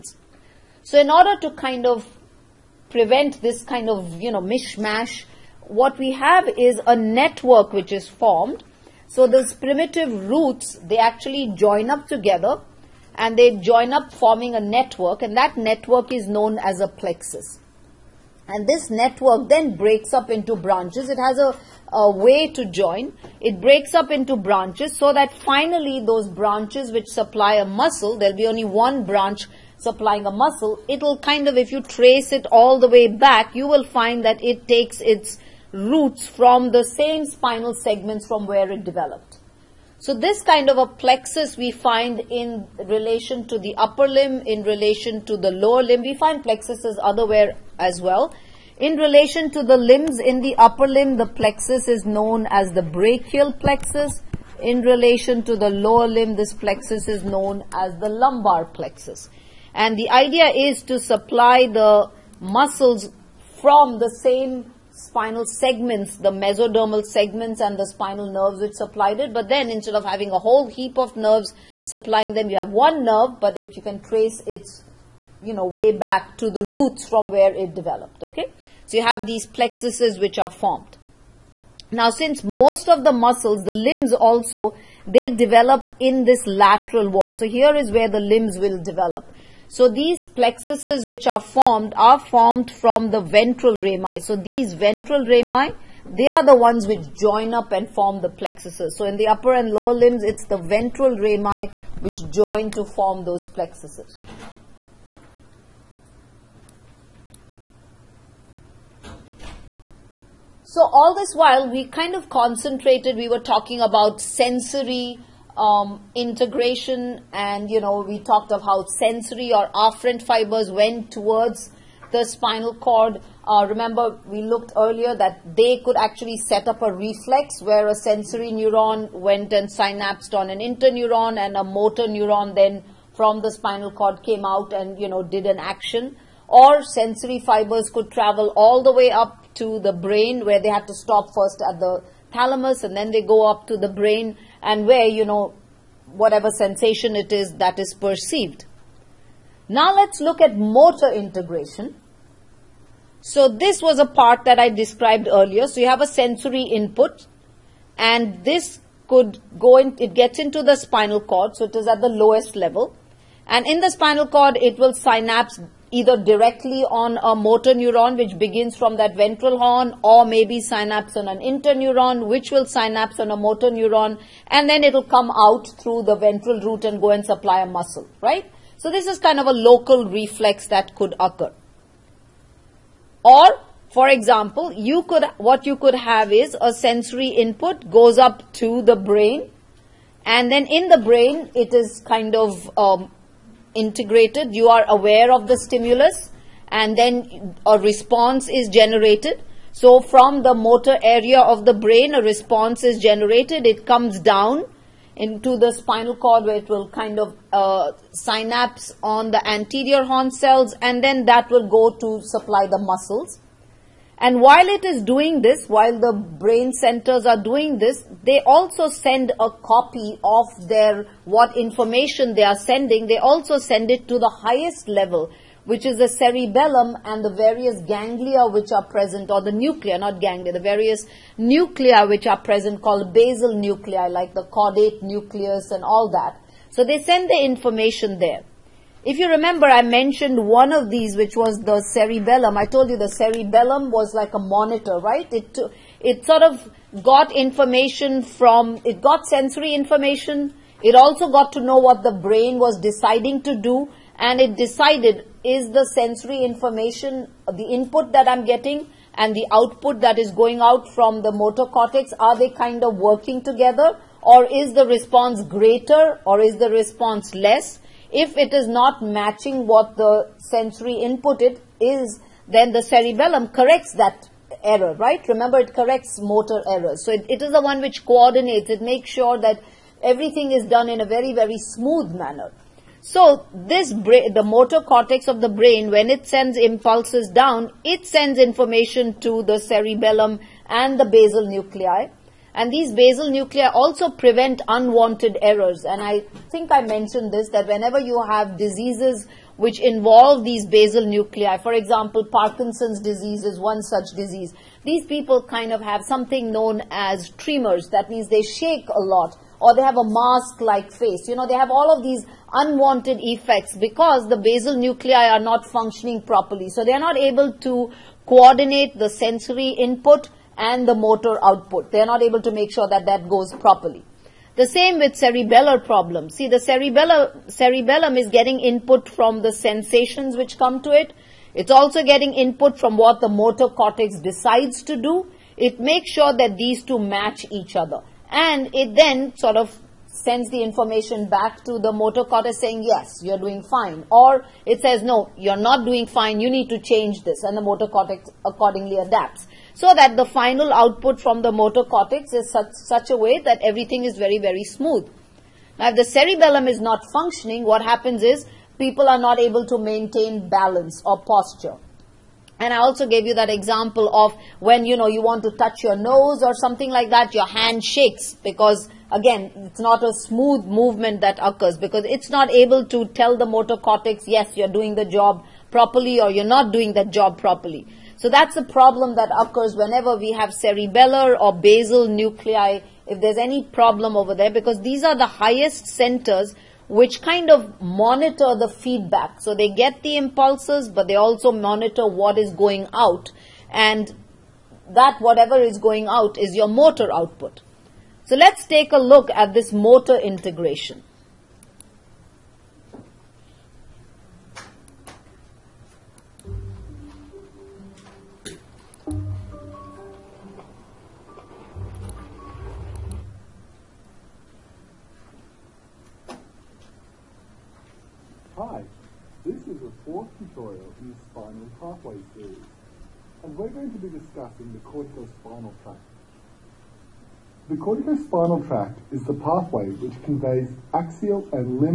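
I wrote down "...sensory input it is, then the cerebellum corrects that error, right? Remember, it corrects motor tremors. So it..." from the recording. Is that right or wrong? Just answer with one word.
wrong.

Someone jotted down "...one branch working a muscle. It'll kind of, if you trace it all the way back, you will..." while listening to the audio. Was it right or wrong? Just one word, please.
wrong.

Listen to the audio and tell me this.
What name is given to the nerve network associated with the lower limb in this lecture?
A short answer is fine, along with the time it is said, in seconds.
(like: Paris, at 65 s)
lumbar plexus, at 58 s.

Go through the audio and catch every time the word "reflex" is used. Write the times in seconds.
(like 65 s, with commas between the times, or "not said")
126 s, 180 s.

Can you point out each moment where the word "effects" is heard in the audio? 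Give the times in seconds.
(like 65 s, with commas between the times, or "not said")
313 s.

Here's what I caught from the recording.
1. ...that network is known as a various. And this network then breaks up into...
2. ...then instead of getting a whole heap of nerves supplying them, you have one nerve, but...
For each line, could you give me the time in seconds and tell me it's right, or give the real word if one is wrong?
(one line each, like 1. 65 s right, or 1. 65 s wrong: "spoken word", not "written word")
1. 15 s wrong: "plexus", not "various"
2. 69 s wrong: "having", not "getting".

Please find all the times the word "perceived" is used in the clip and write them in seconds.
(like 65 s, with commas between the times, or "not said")
147 s.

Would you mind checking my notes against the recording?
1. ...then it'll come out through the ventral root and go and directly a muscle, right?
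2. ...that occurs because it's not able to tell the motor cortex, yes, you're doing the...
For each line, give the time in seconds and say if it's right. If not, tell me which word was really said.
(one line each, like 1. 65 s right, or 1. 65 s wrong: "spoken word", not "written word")
1. 174 s wrong: "supply", not "directly"
2. 371 s right.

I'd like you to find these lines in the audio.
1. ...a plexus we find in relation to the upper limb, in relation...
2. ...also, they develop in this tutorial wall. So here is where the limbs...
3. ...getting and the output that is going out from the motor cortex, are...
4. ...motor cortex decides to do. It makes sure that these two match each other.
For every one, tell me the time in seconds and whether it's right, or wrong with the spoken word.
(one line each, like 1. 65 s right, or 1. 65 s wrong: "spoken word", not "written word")
1. 40 s right
2. 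84 s wrong: "lateral", not "tutorial"
3. 258 s right
4. 333 s right.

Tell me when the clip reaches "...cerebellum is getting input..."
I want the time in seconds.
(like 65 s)
327 s.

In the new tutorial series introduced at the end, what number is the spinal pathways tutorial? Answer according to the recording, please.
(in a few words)
fourth.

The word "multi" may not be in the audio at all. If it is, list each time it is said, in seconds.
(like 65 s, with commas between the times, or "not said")
not said.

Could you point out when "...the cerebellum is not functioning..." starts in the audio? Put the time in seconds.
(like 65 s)
355 s.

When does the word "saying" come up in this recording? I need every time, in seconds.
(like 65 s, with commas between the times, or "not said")
342 s.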